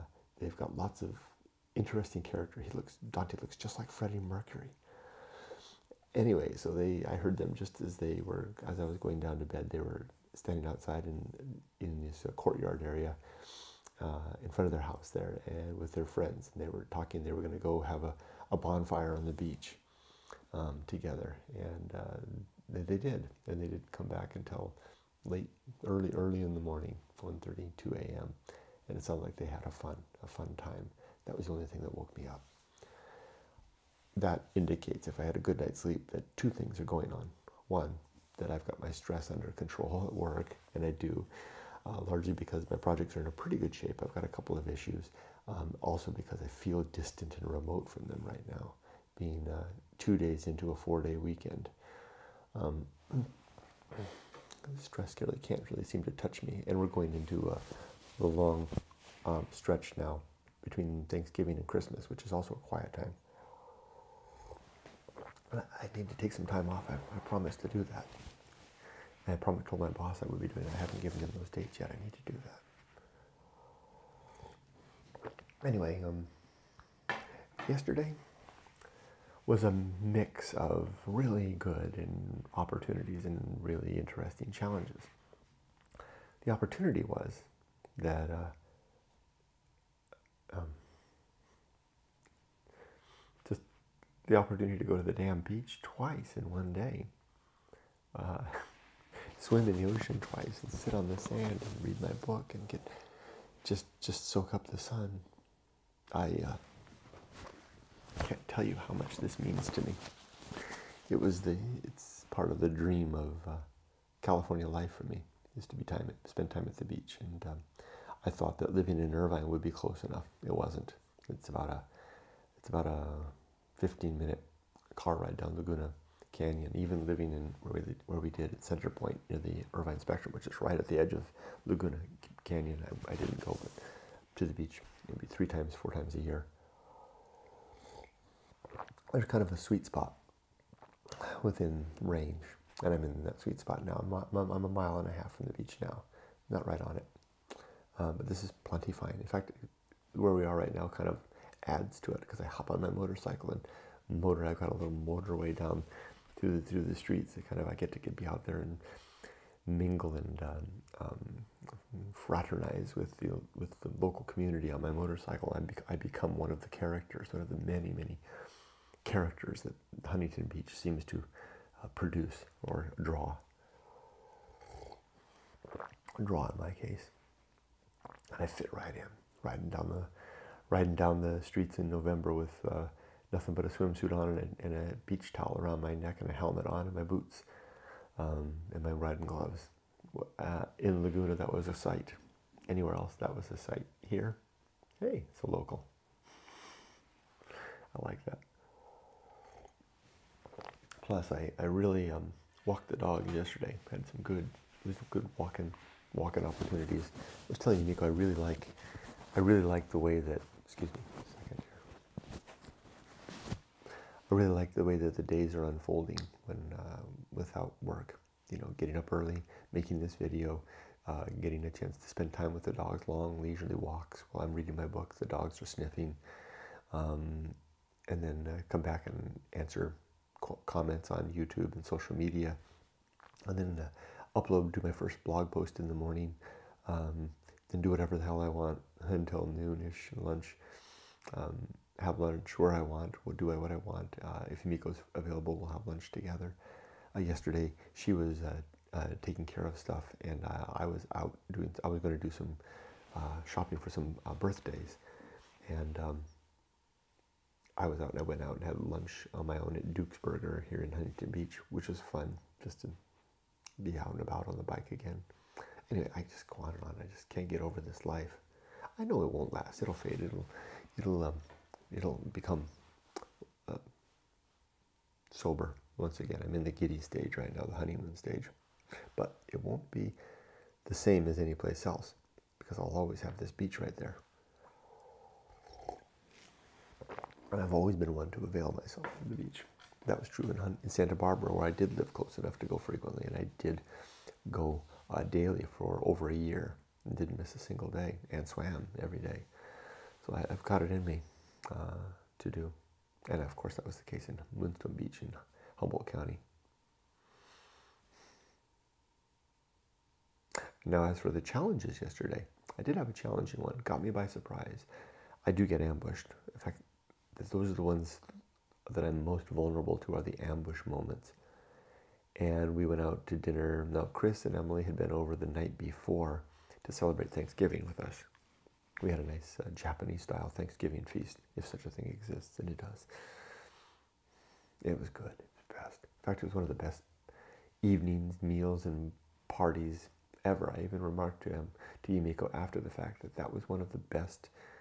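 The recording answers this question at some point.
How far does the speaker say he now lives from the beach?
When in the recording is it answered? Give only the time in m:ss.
2:24.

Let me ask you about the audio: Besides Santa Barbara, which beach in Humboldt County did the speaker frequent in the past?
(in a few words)
Moonstone Beach.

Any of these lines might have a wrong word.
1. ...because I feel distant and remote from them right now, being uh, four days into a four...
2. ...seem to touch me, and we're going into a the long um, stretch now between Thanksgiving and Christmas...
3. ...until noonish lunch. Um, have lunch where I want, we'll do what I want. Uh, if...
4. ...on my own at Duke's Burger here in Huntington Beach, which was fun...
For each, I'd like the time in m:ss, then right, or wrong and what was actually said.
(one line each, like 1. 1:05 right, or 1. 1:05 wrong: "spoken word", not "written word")
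1. 0:46 wrong: "two", not "four"
2. 0:55 right
3. 3:59 right
4. 4:19 right.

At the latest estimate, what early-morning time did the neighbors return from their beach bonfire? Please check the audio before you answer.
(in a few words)
2 a.m.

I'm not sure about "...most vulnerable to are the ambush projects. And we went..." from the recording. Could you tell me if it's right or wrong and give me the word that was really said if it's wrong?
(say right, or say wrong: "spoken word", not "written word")
wrong: "moments", not "projects".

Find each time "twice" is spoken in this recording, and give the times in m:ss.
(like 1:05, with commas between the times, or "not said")
1:35, 1:40.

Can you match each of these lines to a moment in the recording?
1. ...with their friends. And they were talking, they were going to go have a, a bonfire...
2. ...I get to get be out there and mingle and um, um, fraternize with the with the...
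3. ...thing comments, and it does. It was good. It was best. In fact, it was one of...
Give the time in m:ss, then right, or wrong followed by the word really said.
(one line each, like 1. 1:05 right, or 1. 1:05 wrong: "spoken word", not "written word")
1. 0:15 right
2. 2:37 right
3. 5:31 wrong: "exists", not "comments".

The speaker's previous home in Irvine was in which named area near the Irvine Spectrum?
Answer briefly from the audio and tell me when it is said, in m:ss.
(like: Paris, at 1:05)
Center Point, at 2:08.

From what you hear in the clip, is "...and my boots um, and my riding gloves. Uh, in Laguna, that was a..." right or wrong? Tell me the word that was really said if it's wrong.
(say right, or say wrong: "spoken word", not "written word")
right.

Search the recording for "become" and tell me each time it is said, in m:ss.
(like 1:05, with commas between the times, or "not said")
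2:45, 4:32.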